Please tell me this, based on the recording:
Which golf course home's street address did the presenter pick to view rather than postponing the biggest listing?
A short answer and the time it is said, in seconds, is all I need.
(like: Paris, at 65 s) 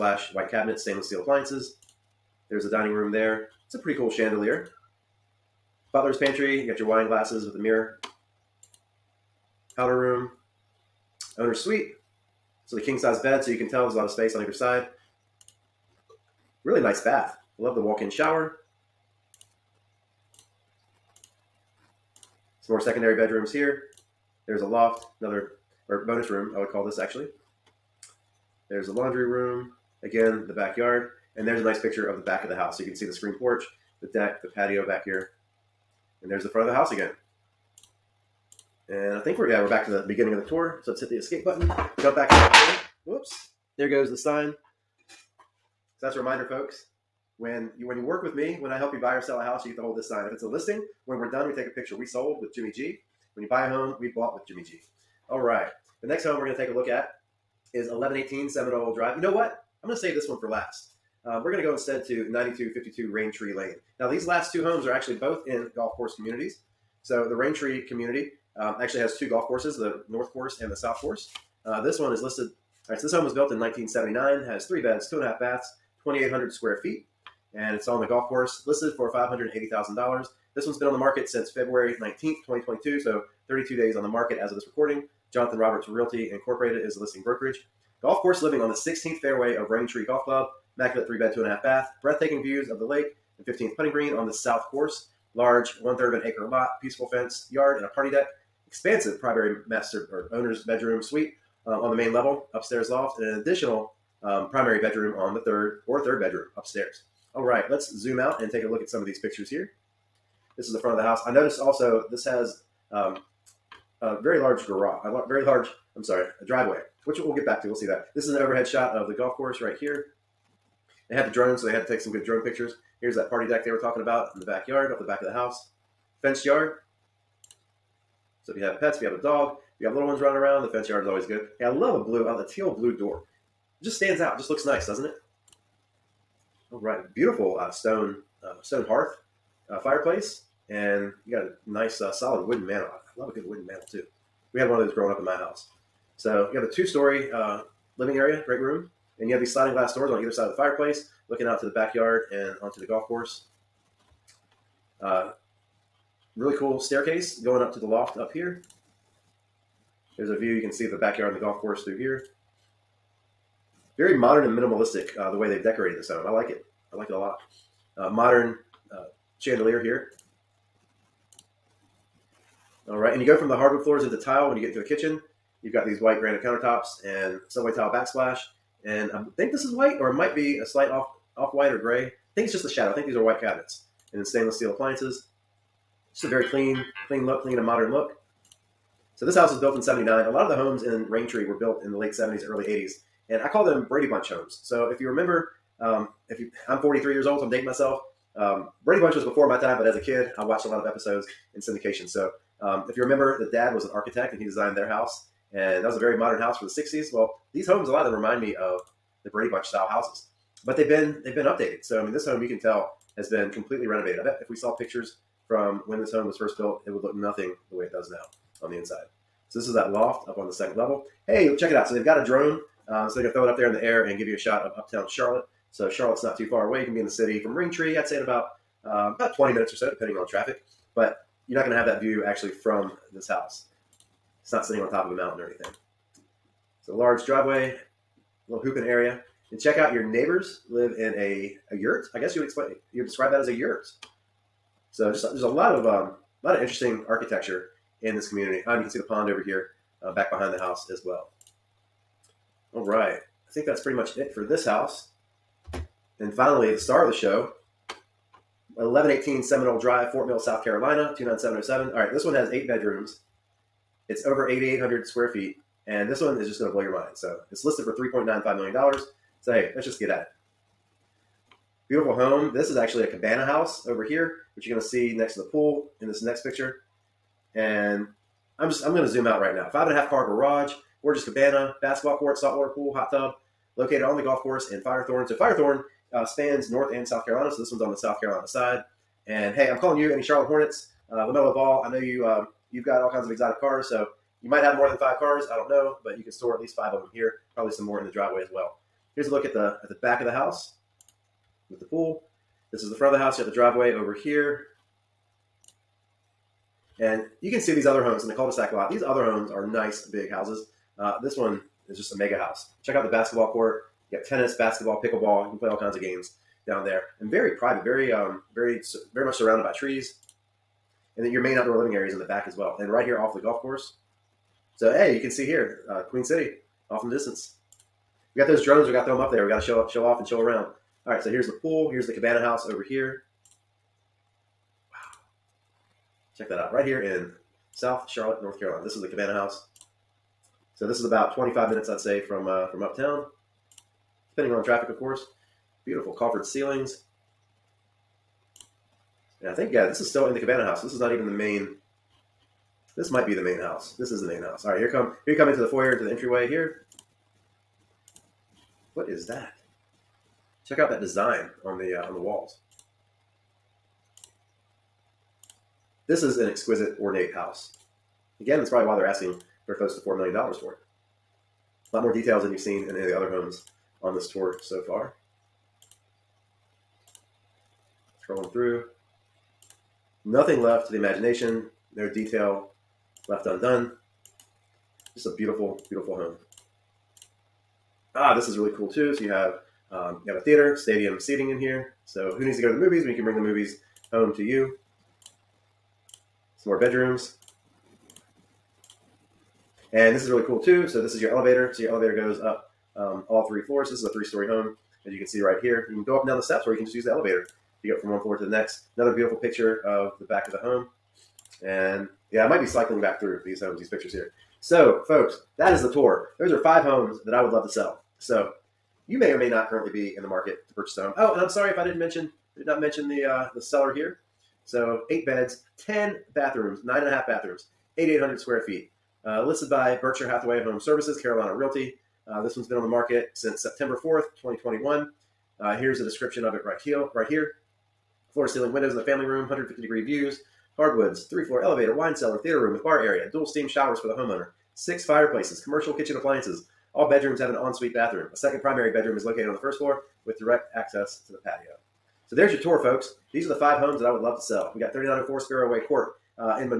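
9252 Raintree Lane, at 62 s.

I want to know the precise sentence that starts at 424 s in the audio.
So eight beds, ten bathrooms, nine and a half bathrooms, eighty eight hundred square feet.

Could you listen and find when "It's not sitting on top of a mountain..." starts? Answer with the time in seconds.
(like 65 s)
234 s.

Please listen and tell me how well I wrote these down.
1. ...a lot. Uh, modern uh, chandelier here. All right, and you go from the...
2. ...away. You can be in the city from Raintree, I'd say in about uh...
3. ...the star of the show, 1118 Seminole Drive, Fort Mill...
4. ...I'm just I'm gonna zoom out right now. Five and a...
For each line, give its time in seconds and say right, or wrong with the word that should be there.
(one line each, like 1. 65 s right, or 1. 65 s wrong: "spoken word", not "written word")
1. 167 s right
2. 226 s right
3. 256 s right
4. 278 s right.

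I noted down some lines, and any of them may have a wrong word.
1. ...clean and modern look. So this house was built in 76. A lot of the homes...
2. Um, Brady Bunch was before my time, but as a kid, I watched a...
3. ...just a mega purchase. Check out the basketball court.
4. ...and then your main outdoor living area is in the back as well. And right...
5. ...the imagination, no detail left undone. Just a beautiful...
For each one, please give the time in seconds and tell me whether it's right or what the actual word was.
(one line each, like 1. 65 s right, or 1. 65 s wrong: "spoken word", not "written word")
1. 187 s wrong: "79", not "76"
2. 198 s right
3. 311 s wrong: "house", not "purchase"
4. 321 s right
5. 380 s right.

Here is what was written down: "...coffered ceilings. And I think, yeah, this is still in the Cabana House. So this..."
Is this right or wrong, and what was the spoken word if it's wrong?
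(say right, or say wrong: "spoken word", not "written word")
right.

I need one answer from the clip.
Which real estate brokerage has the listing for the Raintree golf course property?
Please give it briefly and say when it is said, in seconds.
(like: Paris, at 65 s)
Jonathan Roberts Realty Incorporated, at 85 s.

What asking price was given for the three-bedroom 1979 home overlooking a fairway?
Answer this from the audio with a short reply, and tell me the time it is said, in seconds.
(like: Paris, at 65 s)
$580,000, at 79 s.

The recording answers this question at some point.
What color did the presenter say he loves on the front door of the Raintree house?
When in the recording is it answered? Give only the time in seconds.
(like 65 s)
132 s.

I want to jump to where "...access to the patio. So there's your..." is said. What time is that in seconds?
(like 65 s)
450 s.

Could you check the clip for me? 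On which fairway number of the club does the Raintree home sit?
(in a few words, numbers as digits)
16th.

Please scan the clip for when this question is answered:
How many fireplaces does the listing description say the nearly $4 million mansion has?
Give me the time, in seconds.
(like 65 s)
444 s.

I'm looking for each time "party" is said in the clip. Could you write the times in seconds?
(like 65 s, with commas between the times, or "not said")
97 s, 123 s.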